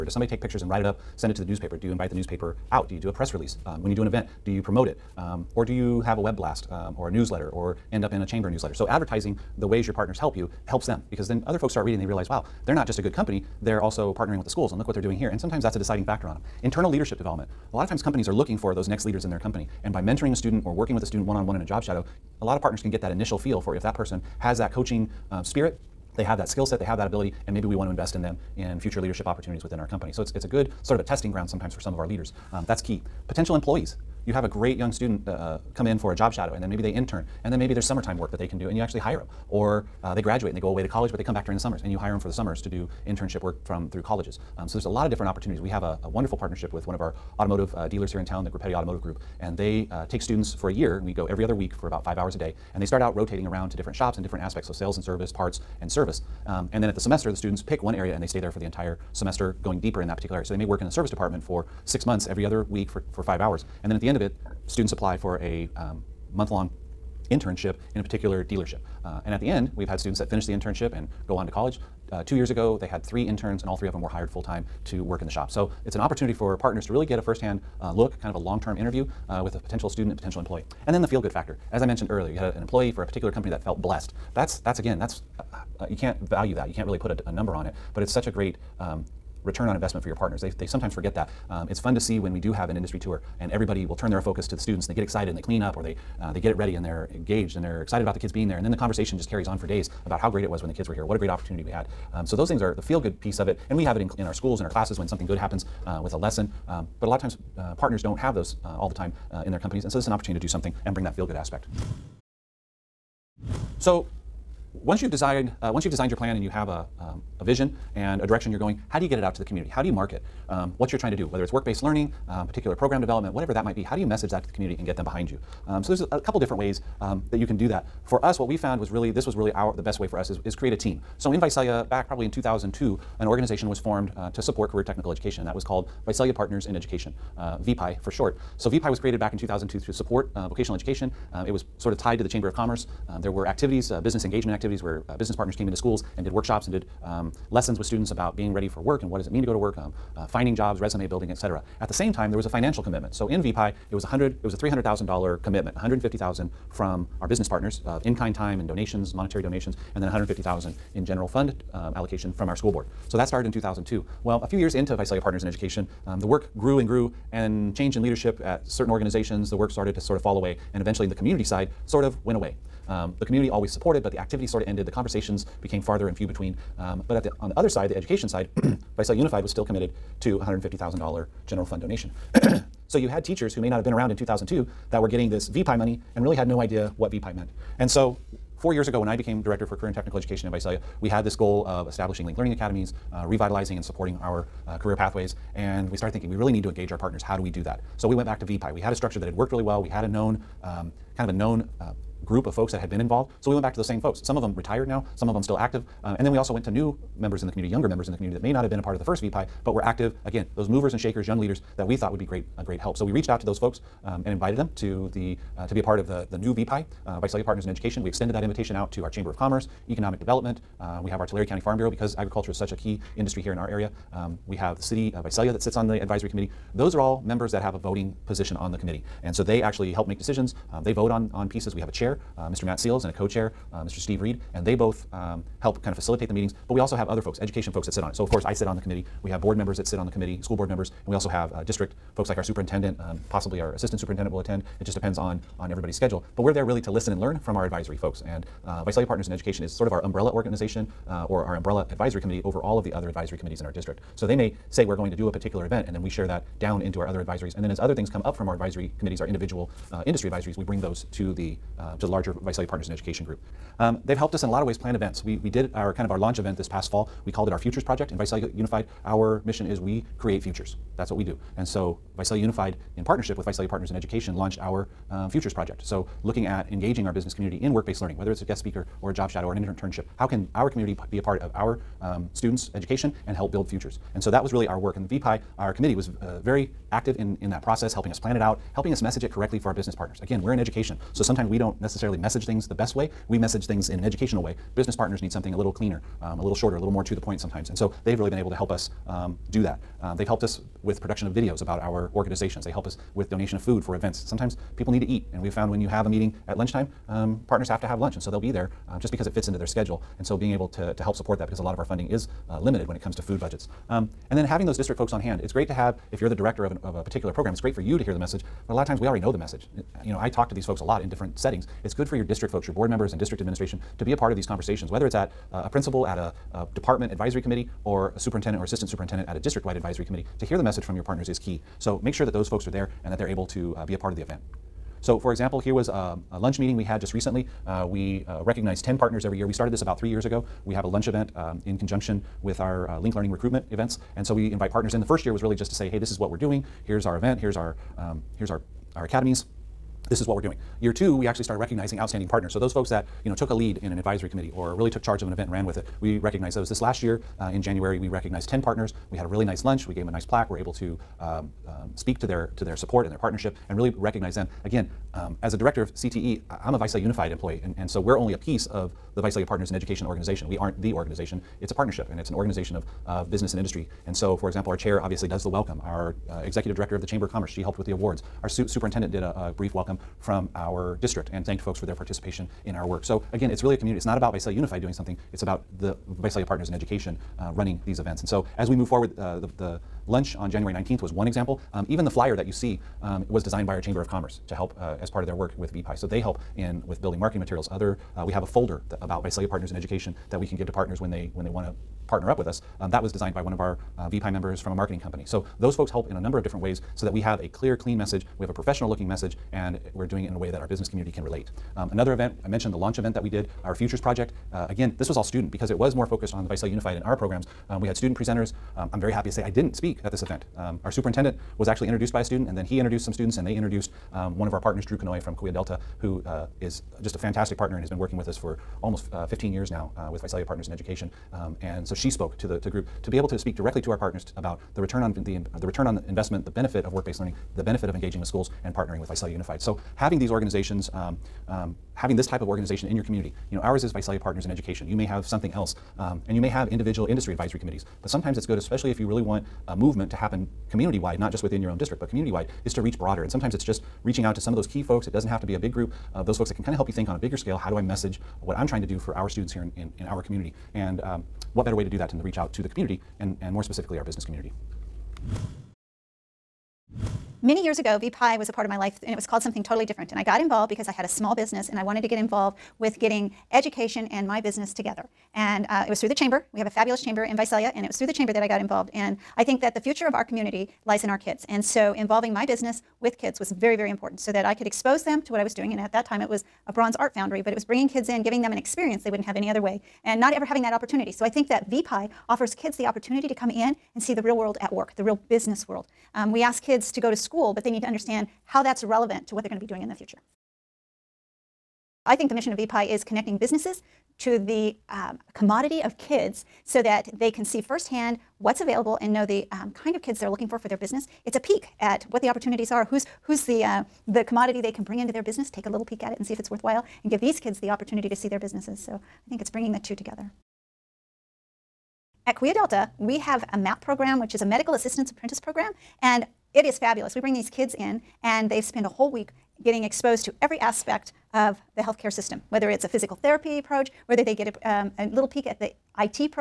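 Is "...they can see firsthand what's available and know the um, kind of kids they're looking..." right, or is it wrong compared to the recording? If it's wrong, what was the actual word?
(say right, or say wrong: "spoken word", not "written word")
right.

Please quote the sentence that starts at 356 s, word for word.
This last year uh, in January, we recognized 10 partners.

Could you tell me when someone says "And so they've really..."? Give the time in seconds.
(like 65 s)
297 s.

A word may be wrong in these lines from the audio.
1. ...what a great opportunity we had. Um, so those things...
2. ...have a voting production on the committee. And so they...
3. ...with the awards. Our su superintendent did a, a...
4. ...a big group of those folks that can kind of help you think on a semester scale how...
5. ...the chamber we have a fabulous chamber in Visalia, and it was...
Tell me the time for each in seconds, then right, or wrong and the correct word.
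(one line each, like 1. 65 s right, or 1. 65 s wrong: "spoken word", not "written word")
1. 101 s right
2. 227 s wrong: "position", not "production"
3. 377 s right
4. 455 s wrong: "bigger", not "semester"
5. 476 s right.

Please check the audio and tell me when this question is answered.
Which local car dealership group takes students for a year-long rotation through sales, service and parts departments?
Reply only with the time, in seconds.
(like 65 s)
48 s.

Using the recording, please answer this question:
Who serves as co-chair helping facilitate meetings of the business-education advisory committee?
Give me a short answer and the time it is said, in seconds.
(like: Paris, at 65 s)
Steve Reed, at 233 s.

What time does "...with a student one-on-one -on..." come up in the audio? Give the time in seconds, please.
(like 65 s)
20 s.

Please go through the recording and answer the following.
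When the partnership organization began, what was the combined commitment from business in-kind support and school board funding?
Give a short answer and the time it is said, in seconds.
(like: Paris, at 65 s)
$300,000, at 154 s.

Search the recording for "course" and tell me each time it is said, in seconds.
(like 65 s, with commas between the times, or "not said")
238 s.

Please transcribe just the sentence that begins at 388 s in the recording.
And so as we move forward, uh, the, the, lunch on January 19th was one example.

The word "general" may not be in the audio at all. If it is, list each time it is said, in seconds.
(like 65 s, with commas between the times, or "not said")
161 s, 181 s.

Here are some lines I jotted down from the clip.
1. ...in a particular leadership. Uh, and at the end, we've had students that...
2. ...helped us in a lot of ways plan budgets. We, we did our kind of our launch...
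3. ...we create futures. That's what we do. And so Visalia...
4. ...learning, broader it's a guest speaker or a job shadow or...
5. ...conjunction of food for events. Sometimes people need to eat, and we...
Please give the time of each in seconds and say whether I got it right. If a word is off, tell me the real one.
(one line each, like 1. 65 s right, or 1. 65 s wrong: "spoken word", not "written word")
1. 67 s wrong: "dealership", not "leadership"
2. 264 s wrong: "events", not "budgets"
3. 269 s right
4. 278 s wrong: "whether", not "broader"
5. 303 s wrong: "donation", not "conjunction".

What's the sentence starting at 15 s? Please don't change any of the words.
And sometimes that's a deciding factor on them.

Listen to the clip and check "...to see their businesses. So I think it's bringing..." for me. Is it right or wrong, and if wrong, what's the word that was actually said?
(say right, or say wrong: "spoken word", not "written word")
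right.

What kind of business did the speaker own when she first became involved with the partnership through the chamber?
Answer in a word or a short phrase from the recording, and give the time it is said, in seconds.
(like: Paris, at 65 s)
bronze art foundry, at 486 s.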